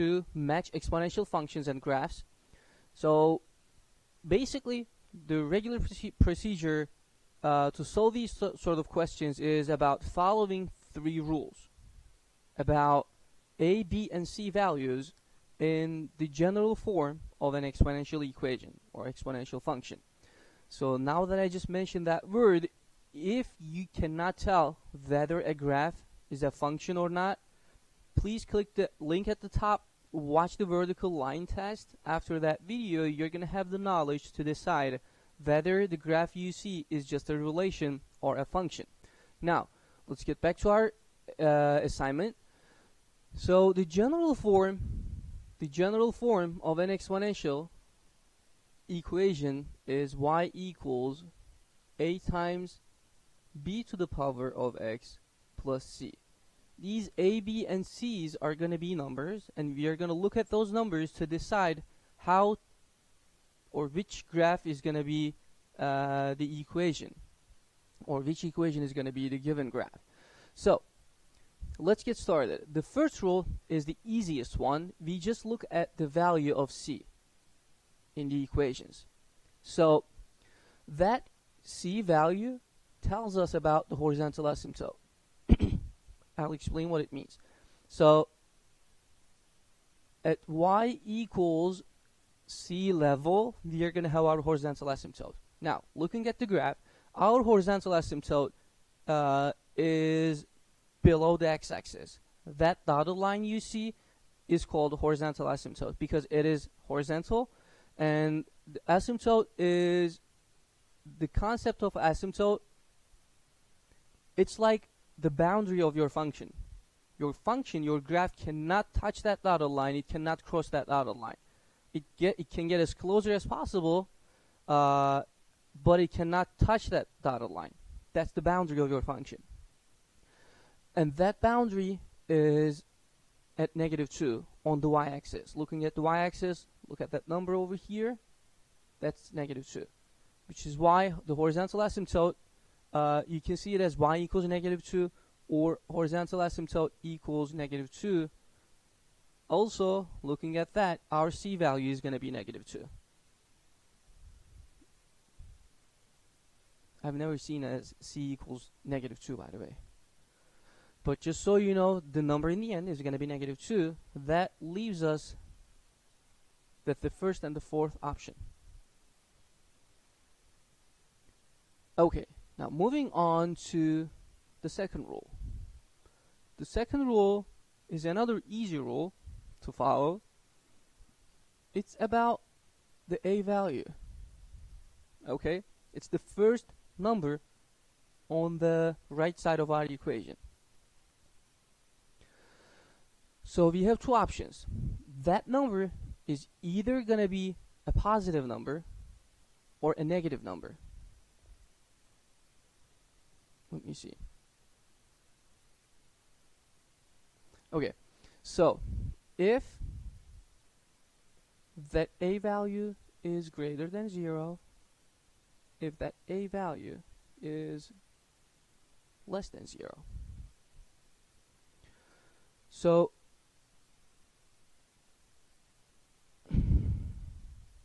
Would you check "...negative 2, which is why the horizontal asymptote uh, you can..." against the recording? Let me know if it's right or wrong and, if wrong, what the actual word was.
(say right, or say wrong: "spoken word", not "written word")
right.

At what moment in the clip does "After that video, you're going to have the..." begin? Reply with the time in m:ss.
0:32.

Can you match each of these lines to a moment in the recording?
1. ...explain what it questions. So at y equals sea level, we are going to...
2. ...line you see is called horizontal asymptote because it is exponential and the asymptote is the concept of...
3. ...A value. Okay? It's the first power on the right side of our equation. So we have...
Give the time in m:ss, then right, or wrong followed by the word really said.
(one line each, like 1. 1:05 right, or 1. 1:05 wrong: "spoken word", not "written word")
1. 1:26 wrong: "means", not "questions"
2. 1:43 wrong: "horizontal", not "exponential"
3. 3:03 wrong: "number", not "power".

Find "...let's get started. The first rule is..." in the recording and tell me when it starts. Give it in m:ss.
1:11.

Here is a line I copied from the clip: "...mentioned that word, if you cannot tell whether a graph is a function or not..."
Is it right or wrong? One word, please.
right.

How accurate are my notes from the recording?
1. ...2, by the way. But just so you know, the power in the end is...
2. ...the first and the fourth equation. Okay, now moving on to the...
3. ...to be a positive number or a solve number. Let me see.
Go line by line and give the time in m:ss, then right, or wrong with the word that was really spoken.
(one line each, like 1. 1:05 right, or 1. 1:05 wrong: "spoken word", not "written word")
1. 2:39 wrong: "number", not "power"
2. 2:46 wrong: "option", not "equation"
3. 3:17 wrong: "negative", not "solve".